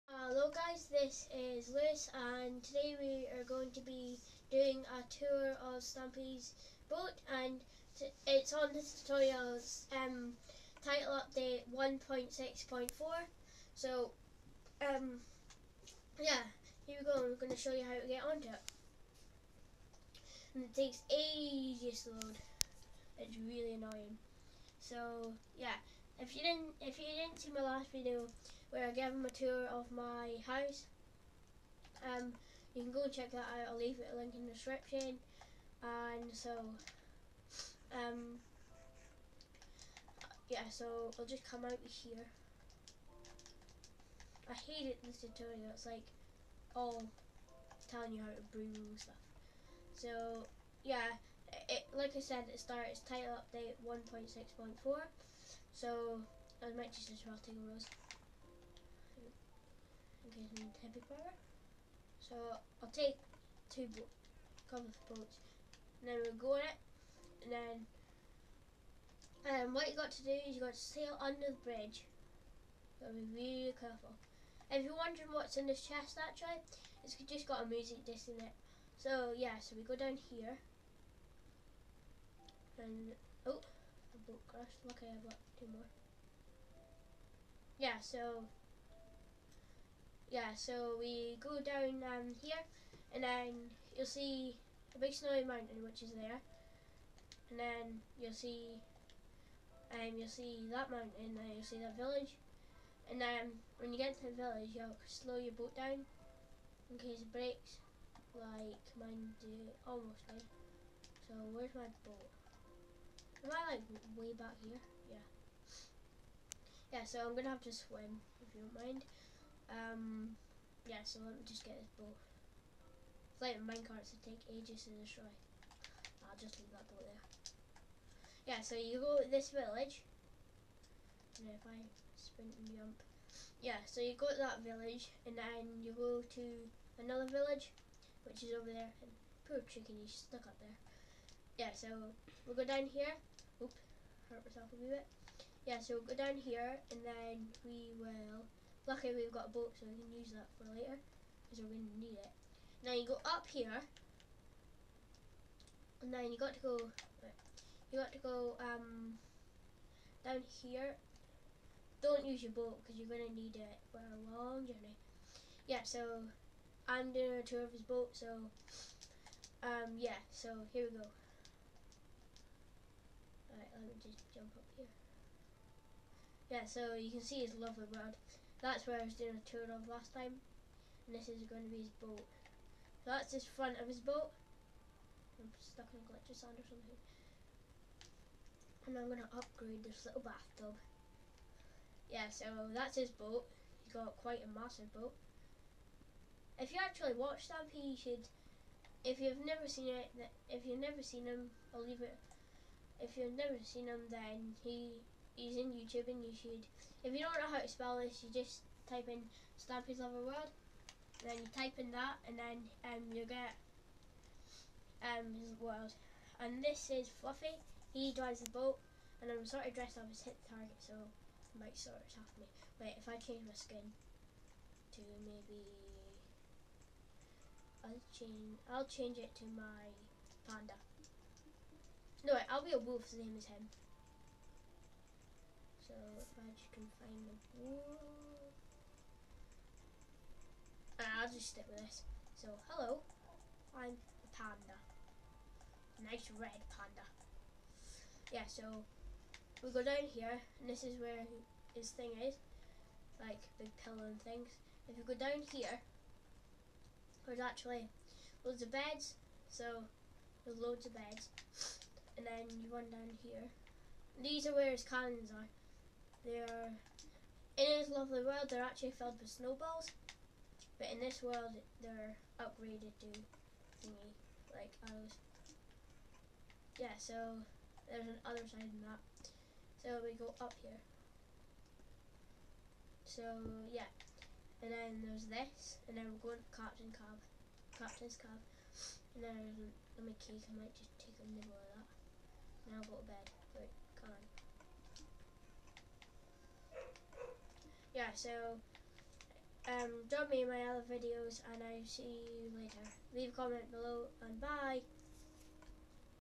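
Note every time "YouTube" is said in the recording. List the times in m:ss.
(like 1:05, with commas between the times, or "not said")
3:25.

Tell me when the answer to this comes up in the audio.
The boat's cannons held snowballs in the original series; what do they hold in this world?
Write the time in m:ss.
4:34.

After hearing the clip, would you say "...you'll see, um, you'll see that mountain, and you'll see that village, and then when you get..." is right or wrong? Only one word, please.
right.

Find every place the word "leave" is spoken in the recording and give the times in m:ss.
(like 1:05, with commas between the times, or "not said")
0:33, 2:06, 3:21, 5:03.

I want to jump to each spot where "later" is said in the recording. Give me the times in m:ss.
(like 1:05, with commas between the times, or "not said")
2:30, 5:02.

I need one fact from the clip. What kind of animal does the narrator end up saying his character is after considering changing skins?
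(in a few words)
Red panda.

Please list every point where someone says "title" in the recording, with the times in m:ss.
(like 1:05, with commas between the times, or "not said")
0:10, 0:53.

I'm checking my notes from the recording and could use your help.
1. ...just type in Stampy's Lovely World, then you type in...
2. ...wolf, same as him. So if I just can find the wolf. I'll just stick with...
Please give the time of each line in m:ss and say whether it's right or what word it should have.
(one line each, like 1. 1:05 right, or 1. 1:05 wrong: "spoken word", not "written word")
1. 3:28 right
2. 3:52 right.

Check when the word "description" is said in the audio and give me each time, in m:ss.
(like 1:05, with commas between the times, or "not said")
0:34.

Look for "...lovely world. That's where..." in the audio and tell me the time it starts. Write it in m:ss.
2:57.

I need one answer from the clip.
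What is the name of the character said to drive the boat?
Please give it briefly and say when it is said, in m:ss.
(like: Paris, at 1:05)
Fluffy, at 3:37.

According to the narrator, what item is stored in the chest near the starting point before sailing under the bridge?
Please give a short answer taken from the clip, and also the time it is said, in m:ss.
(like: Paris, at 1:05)
A music disc, at 1:17.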